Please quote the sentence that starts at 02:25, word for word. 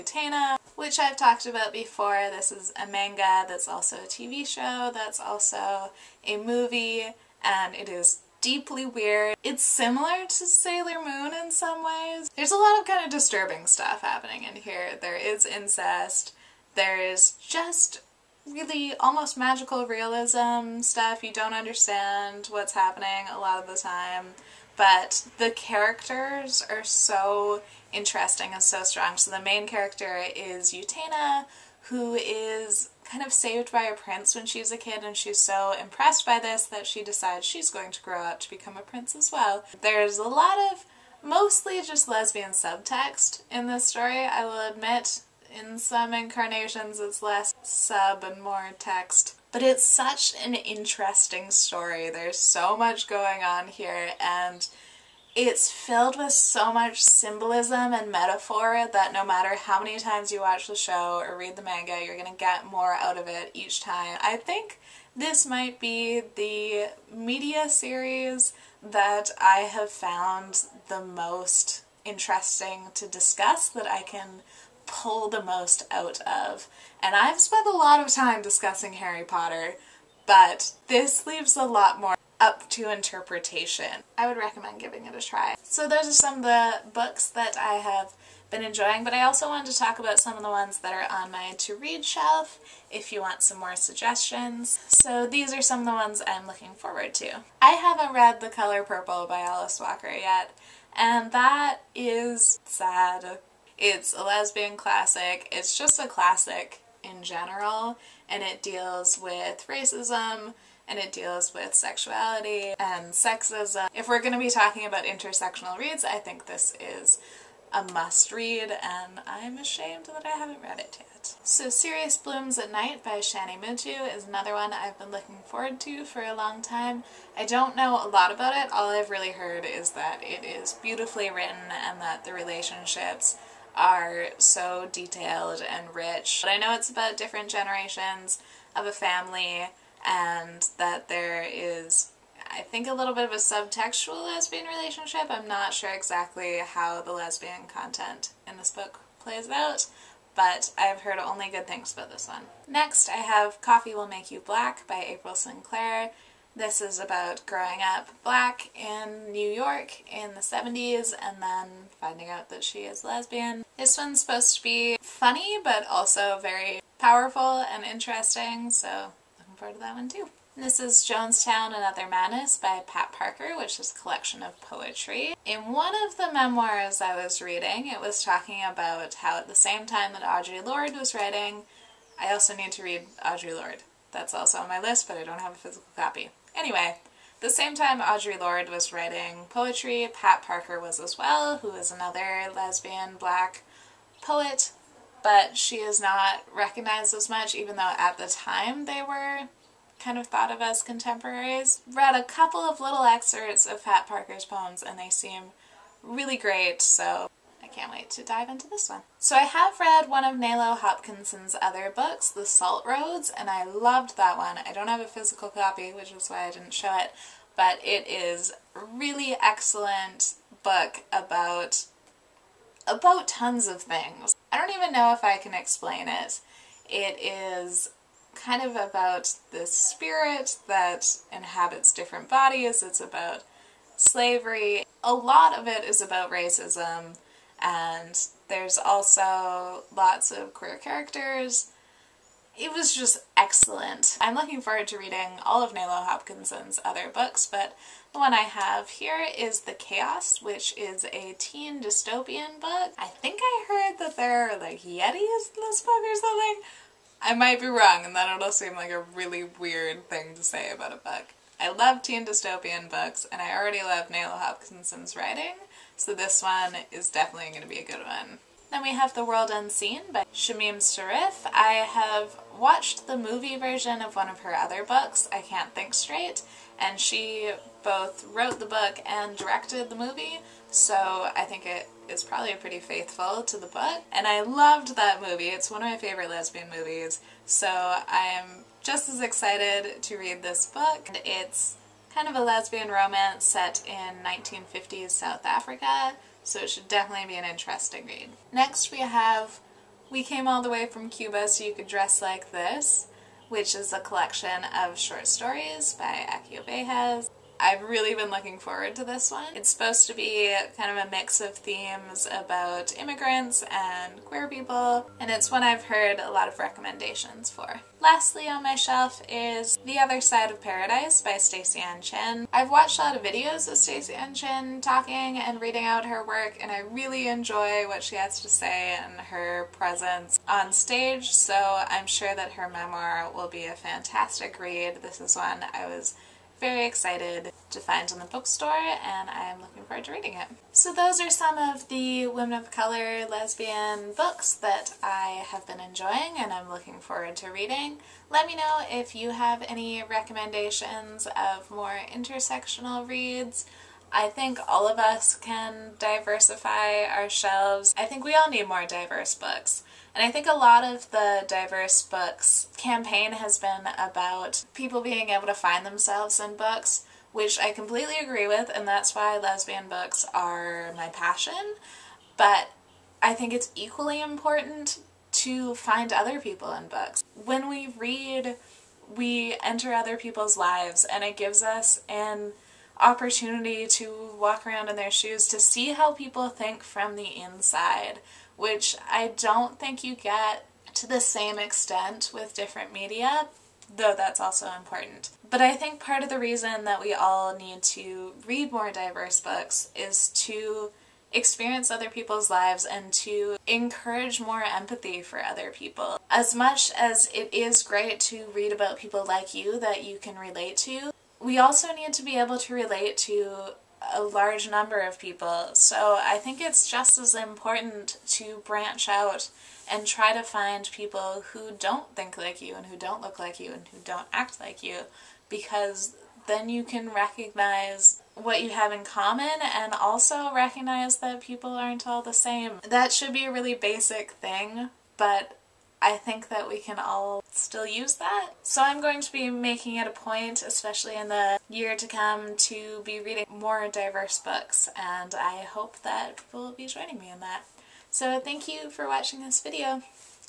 I'm not sure exactly how the lesbian content in this book plays out, but I've heard only good things about this one.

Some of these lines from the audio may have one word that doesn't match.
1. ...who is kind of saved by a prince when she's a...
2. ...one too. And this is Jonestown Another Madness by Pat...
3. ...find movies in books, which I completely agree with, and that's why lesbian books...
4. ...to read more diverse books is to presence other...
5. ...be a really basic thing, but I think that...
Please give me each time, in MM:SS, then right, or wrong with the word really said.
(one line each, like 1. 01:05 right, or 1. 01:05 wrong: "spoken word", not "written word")
1. 00:31 right
2. 02:49 right
3. 06:05 wrong: "themselves", not "movies"
4. 06:37 wrong: "experience", not "presence"
5. 07:13 right.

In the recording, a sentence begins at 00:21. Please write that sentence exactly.
You don't understand what's happening a lot of the time, but the characters are so interesting and so strong.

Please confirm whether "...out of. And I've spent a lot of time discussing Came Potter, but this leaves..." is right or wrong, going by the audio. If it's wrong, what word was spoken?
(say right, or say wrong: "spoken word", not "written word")
wrong: "Harry", not "Came".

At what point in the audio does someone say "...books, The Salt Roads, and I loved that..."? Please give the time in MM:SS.
03:31.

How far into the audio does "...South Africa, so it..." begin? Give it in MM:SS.
04:55.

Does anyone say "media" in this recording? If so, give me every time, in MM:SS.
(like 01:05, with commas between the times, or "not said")
01:07, 06:32.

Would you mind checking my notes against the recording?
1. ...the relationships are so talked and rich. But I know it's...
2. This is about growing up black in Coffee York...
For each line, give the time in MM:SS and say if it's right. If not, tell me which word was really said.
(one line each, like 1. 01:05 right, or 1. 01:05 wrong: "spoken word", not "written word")
1. 02:12 wrong: "detailed", not "talked"
2. 02:36 wrong: "New", not "Coffee".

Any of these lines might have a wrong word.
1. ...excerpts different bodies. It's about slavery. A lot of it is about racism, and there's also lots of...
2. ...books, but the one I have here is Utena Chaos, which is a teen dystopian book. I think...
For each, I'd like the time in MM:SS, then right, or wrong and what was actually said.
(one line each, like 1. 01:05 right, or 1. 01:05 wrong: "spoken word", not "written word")
1. 03:51 wrong: "inhabits", not "excerpts"
2. 04:07 wrong: "The", not "Utena".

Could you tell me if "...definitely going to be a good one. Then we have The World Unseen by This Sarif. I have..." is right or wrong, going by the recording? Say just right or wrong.
wrong.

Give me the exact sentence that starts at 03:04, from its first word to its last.
That's also on my list, but I don't have a physical copy.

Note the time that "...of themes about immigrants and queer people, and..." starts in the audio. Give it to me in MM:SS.
05:11.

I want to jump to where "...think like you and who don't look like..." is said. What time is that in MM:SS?
07:02.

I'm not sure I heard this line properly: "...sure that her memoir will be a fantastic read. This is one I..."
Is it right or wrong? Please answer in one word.
right.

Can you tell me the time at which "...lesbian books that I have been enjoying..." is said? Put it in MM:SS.
05:43.